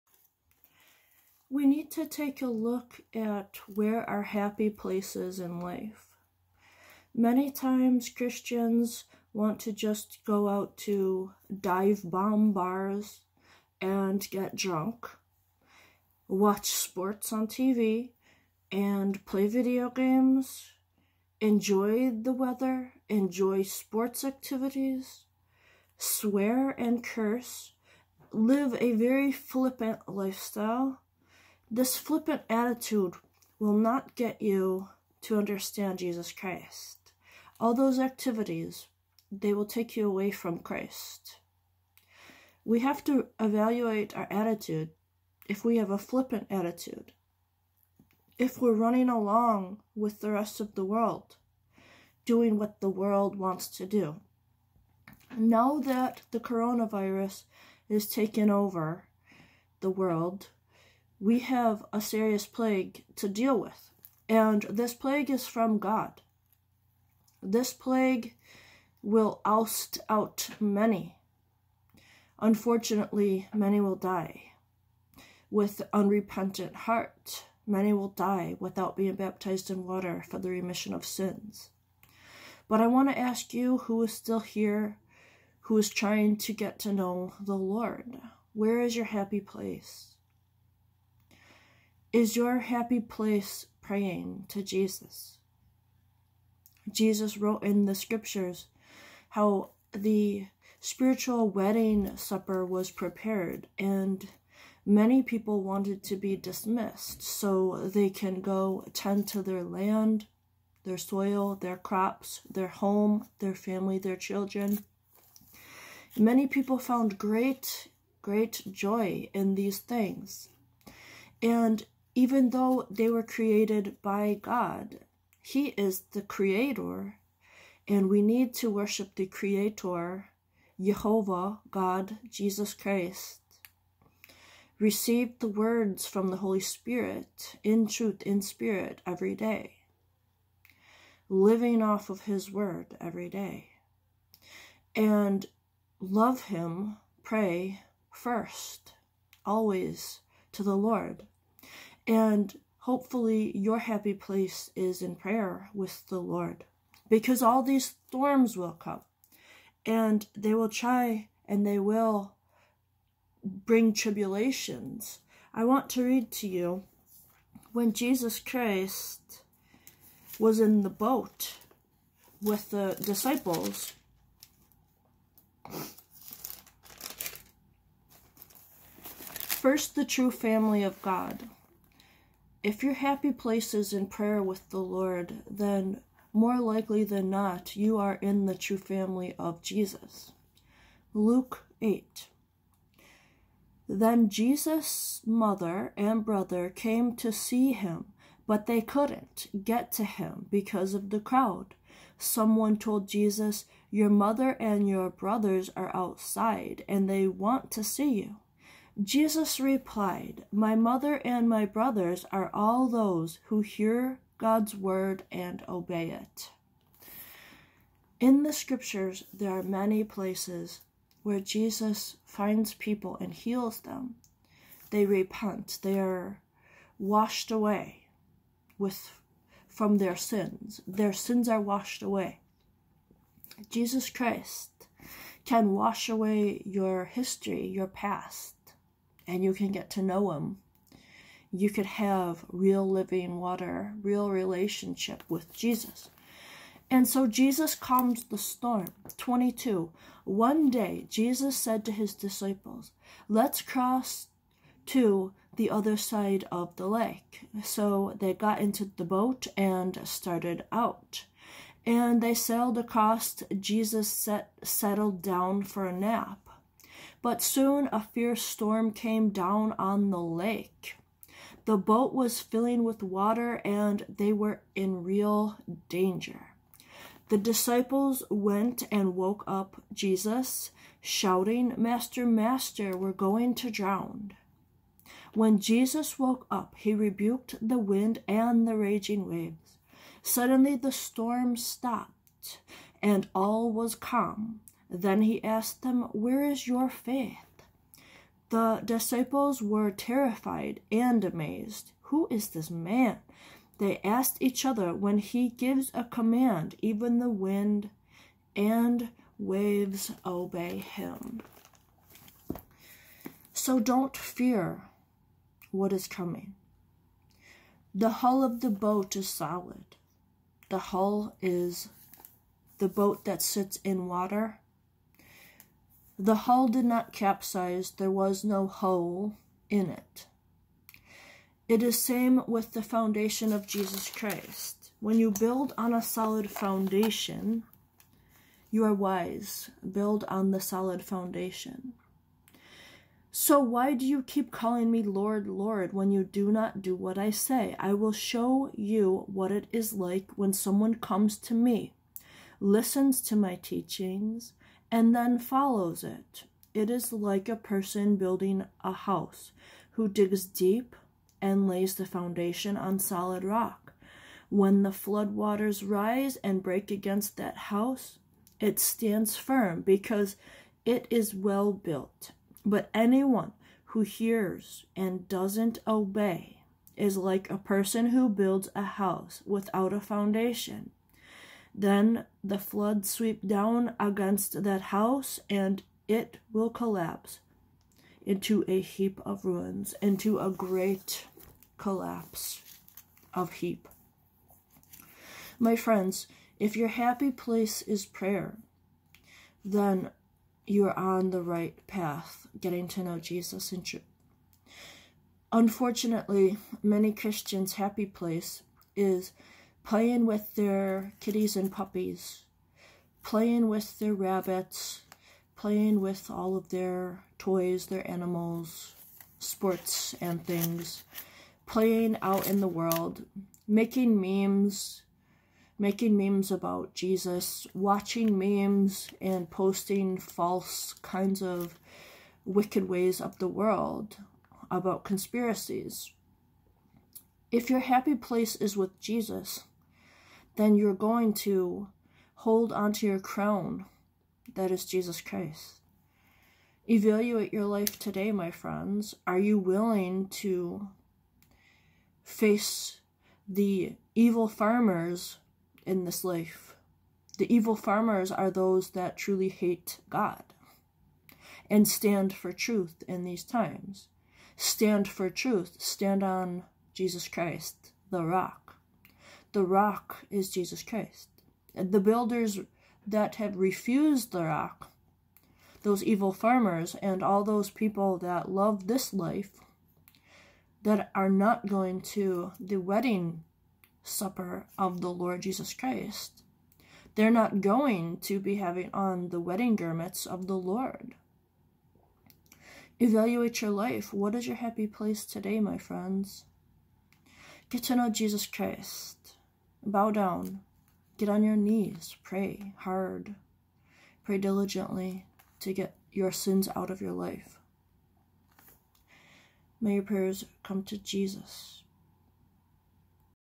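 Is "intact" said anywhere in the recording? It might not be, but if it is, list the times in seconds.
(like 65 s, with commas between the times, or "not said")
not said.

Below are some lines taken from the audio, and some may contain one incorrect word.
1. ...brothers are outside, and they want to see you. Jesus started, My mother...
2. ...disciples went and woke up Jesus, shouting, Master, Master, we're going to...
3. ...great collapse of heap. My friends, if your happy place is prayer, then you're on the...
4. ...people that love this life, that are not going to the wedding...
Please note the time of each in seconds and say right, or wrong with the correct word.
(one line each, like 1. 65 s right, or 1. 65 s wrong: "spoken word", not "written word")
1. 205 s wrong: "replied", not "started"
2. 277 s right
3. 390 s right
4. 477 s right.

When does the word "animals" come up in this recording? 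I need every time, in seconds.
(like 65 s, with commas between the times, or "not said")
418 s.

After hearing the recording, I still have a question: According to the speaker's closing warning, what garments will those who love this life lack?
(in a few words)
Wedding garments.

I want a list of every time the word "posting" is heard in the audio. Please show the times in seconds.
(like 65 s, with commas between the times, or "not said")
429 s.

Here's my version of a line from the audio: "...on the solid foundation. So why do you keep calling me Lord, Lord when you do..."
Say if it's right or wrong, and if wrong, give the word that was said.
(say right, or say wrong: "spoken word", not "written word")
right.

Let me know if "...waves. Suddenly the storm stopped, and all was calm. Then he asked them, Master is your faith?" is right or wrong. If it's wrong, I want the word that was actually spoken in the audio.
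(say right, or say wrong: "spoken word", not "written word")
wrong: "Where", not "Master".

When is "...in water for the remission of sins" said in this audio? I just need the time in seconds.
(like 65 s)
79 s.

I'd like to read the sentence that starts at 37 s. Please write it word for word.
All those activities, they will take you away from Christ.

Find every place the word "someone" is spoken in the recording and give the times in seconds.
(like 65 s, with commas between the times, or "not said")
202 s, 350 s.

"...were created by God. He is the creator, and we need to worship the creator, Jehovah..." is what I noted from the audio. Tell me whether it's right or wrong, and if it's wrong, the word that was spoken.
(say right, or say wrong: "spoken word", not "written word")
right.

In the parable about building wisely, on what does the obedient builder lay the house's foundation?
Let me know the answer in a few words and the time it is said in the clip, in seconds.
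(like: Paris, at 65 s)
Solid rock, at 362 s.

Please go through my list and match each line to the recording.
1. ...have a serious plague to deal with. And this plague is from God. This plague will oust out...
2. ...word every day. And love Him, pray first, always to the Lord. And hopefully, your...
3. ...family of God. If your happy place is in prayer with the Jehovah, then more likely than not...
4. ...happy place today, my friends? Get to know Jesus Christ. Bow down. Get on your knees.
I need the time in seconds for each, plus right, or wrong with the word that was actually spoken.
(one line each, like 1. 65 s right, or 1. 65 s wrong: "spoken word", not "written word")
1. 61 s right
2. 142 s right
3. 180 s wrong: "Lord", not "Jehovah"
4. 494 s right.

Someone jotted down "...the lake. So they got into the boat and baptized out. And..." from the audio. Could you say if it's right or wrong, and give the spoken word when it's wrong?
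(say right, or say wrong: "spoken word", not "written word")
wrong: "started", not "baptized".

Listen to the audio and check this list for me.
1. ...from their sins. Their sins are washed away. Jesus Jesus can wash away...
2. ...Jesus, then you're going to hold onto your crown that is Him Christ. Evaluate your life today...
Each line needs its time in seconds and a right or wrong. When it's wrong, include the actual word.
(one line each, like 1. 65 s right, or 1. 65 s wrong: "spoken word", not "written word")
1. 229 s wrong: "Christ", not "Jesus"
2. 439 s wrong: "Jesus", not "Him".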